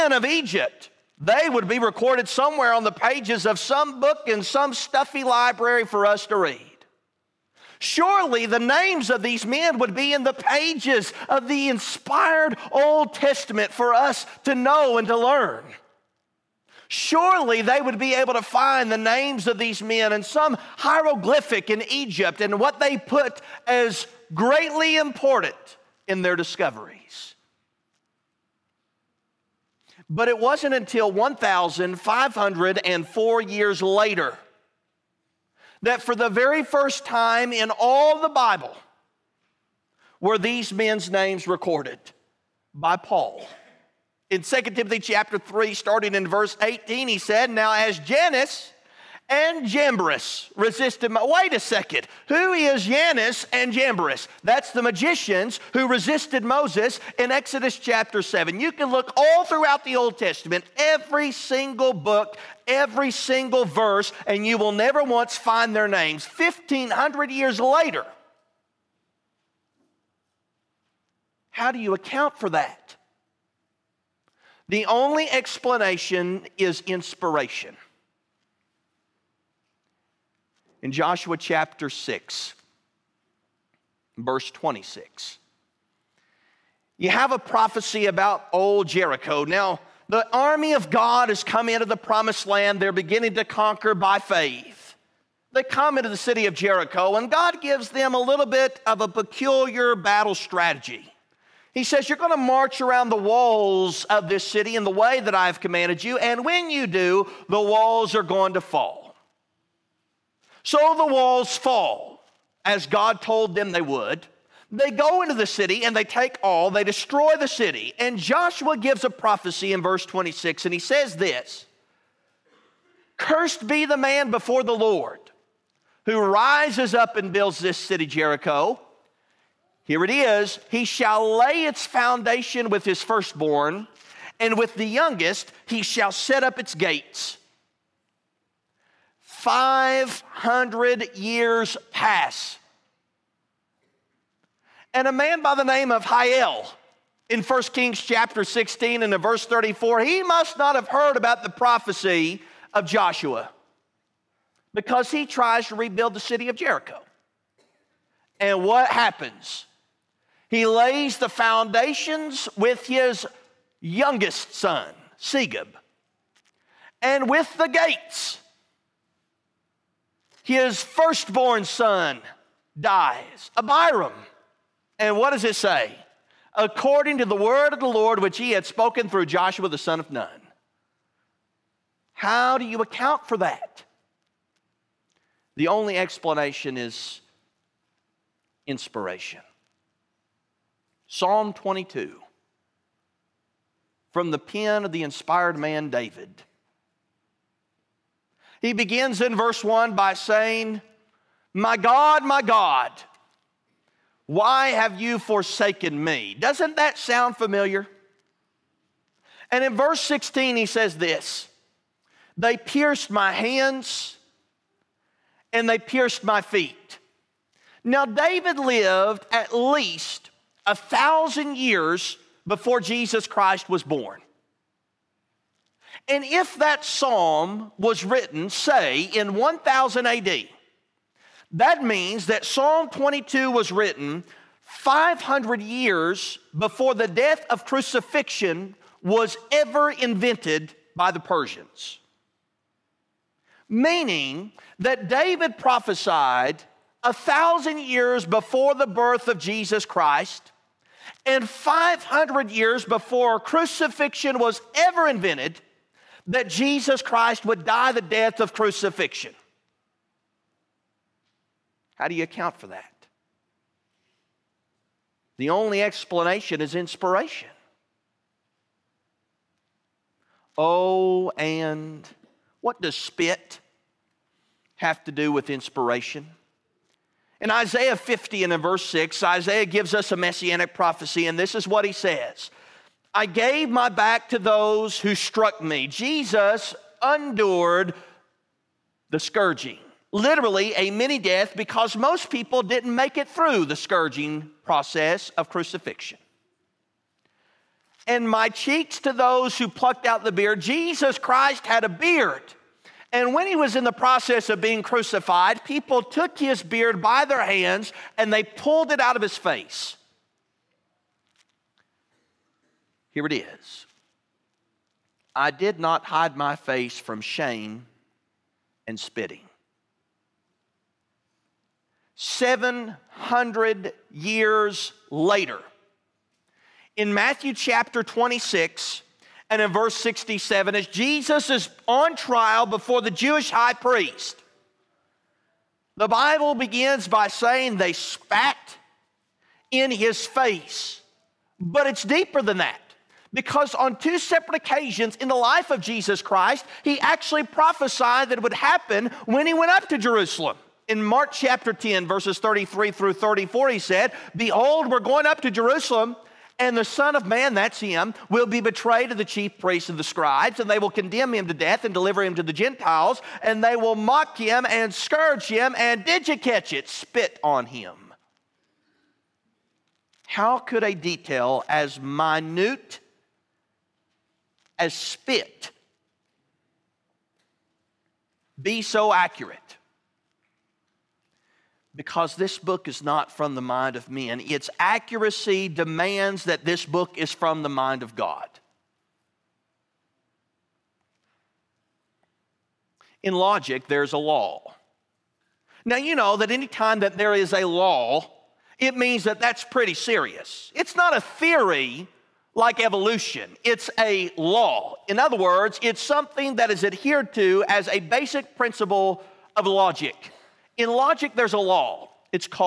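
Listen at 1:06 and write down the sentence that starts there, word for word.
1,500 years later, how do you account for that?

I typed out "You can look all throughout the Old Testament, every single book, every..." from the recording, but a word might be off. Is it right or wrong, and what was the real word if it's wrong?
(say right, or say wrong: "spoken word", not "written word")
right.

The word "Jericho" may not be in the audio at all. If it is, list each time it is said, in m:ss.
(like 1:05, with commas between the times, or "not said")
1:28, 1:36, 2:08, 2:36.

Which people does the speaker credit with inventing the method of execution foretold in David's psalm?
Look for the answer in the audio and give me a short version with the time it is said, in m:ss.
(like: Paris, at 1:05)
The Persians, at 4:01.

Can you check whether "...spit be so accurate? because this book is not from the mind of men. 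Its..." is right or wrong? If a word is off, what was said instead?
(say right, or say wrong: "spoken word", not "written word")
right.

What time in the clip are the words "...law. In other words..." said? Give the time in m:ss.
6:44.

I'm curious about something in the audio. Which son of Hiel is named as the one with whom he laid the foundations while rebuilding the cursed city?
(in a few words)
Segub.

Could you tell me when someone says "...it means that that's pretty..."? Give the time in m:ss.
6:38.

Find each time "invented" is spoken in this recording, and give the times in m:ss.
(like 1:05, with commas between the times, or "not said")
3:59, 4:15.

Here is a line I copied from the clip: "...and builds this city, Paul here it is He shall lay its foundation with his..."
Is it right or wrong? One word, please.
wrong.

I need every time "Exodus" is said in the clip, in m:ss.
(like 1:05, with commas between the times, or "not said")
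0:57.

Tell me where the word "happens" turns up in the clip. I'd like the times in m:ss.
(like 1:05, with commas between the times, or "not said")
2:38, 5:48.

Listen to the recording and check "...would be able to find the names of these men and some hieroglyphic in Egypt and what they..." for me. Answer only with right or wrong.
right.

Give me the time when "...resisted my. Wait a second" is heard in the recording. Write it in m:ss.
0:50.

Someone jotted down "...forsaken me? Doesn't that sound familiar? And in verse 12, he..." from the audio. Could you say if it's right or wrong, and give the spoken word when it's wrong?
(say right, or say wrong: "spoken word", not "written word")
wrong: "16", not "12".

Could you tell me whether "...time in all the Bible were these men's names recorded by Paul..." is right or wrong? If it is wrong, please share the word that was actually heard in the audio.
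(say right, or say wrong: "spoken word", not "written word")
right.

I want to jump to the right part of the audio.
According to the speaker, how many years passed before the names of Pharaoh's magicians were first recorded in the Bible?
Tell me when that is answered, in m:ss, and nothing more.
0:31.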